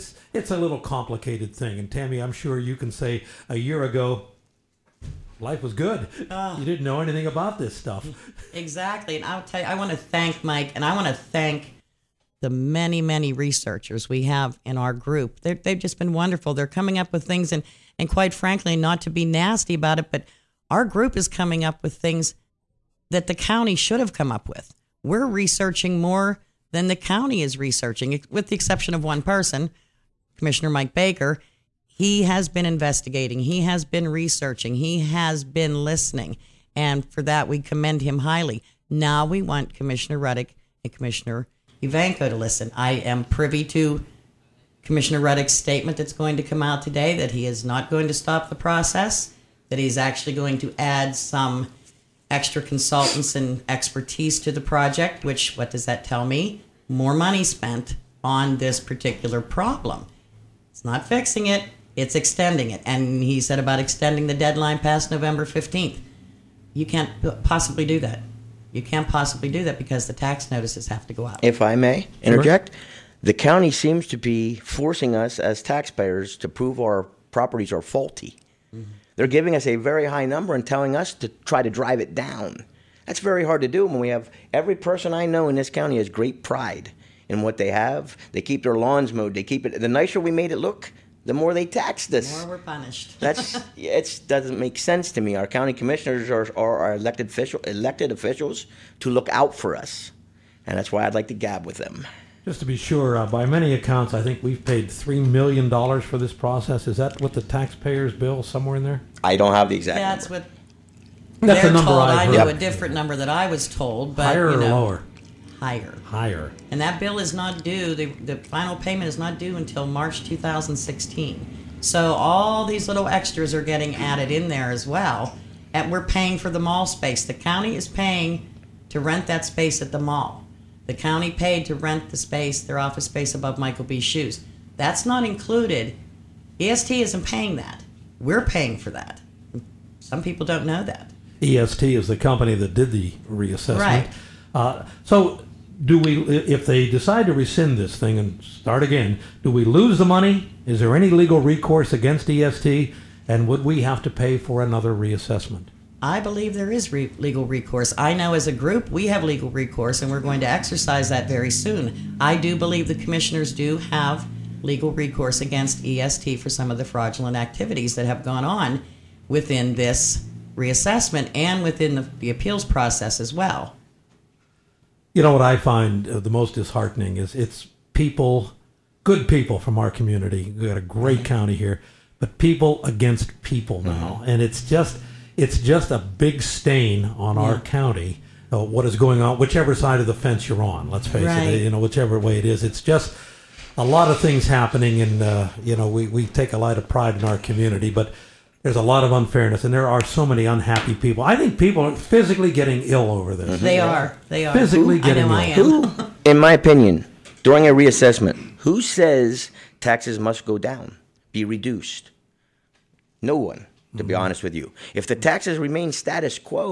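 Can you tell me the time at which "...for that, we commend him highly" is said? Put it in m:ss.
0:37.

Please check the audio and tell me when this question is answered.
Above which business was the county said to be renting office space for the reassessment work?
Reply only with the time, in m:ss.
2:13.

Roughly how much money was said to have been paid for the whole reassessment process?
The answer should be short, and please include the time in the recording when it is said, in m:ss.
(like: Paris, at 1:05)
$3 million, at 1:44.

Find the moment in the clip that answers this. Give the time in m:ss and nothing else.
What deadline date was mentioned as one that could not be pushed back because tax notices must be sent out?
1:05.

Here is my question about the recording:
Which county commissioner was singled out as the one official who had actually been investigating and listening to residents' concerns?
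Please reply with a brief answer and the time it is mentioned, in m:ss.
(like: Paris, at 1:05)
Mike Baker, at 0:30.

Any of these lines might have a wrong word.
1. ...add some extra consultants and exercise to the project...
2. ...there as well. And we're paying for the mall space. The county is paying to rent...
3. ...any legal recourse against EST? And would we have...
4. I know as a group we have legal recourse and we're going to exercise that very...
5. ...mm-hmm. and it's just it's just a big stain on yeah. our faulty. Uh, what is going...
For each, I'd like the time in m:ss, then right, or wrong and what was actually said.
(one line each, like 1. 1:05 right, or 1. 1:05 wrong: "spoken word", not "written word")
1. 0:50 wrong: "expertise", not "exercise"
2. 2:04 right
3. 2:30 right
4. 2:37 right
5. 3:04 wrong: "county", not "faulty".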